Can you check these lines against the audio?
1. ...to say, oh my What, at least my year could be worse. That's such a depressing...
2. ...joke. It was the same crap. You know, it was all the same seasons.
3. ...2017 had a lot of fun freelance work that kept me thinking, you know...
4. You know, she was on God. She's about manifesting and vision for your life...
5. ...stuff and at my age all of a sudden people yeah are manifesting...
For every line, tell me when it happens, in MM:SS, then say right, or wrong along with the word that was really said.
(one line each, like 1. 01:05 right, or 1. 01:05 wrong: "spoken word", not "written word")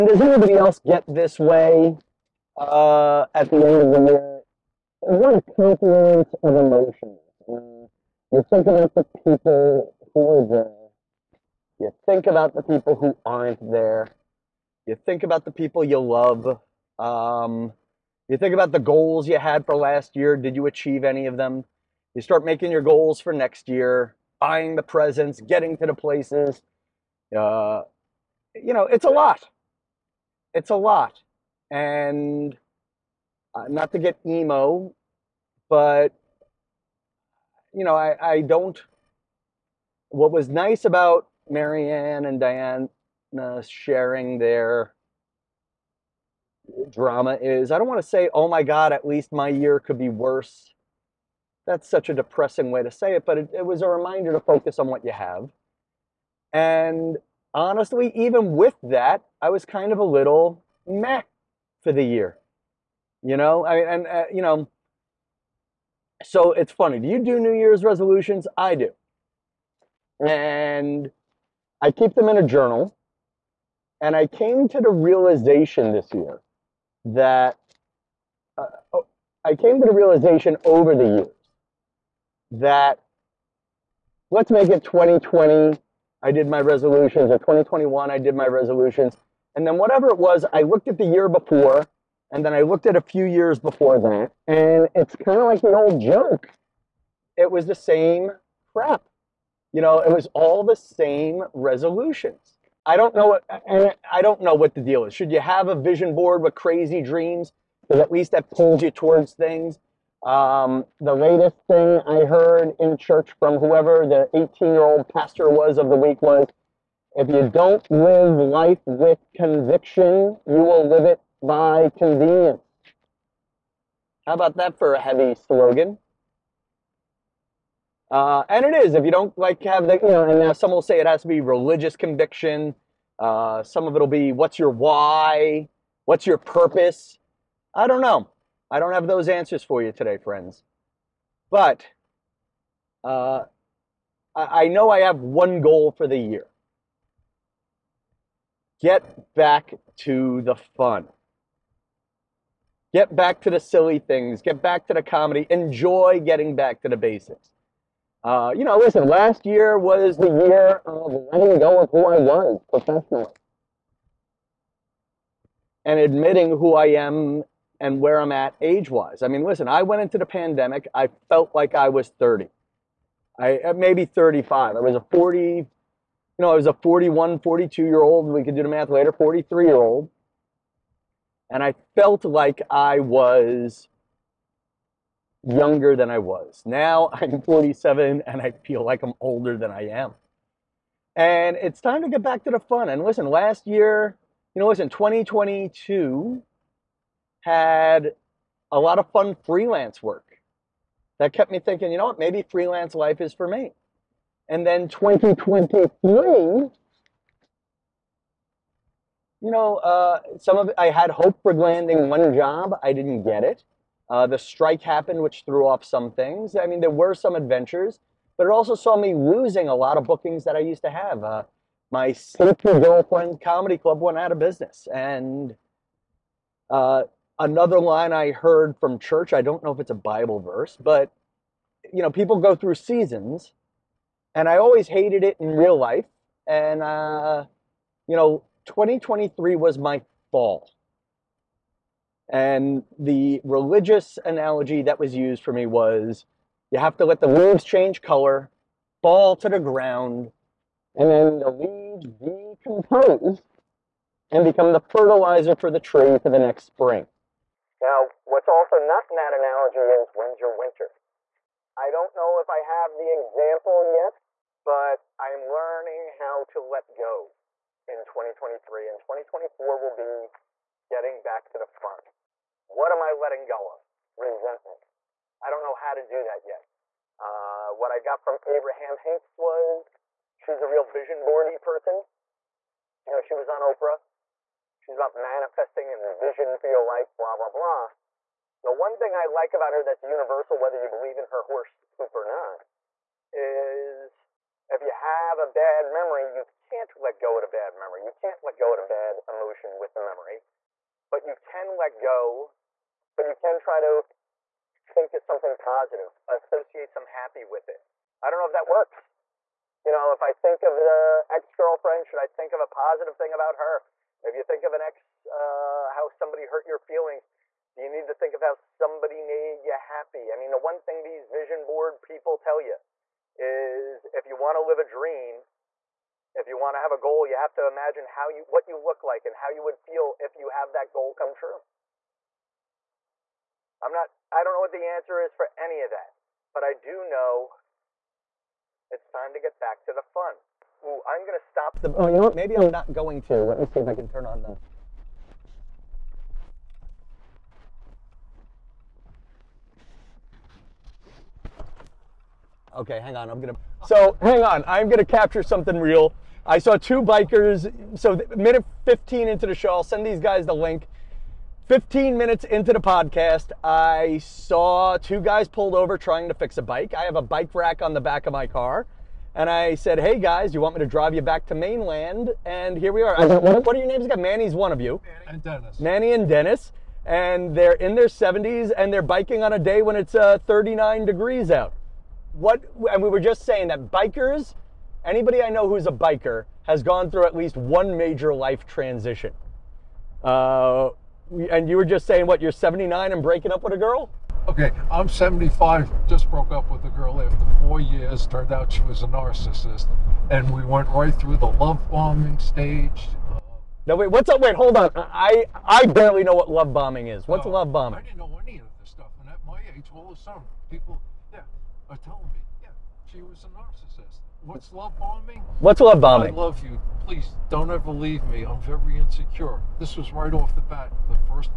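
1. 00:48 wrong: "God", not "What"
2. 01:36 wrong: "resolutions", not "seasons"
3. 03:14 wrong: "2022", not "2017"
4. 04:43 wrong: "Oprah", not "God"
5. 06:48 wrong: "telling", not "manifesting".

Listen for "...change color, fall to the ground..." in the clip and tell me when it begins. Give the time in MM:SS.
04:07.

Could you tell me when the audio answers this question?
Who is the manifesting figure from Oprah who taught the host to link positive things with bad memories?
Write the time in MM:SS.
04:38.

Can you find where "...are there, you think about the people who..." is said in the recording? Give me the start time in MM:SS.
00:10.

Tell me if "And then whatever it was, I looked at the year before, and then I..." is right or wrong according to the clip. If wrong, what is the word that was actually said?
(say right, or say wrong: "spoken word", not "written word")
right.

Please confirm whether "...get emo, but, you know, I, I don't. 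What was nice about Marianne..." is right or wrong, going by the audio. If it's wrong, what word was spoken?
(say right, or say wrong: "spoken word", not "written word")
right.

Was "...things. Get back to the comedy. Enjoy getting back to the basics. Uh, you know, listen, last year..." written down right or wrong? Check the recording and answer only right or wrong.
right.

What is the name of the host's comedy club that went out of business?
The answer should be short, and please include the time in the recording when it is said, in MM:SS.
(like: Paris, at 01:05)
Sleepy Girlfriend Comedy Club, at 03:42.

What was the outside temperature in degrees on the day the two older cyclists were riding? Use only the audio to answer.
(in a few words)
39.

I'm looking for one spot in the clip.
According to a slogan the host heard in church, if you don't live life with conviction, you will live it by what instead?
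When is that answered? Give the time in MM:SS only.
02:01.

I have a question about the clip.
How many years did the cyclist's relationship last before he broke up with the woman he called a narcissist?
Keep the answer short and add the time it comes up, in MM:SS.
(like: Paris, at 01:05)
4, at 06:37.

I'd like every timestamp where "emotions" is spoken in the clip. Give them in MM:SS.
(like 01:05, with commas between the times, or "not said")
00:06, 04:59.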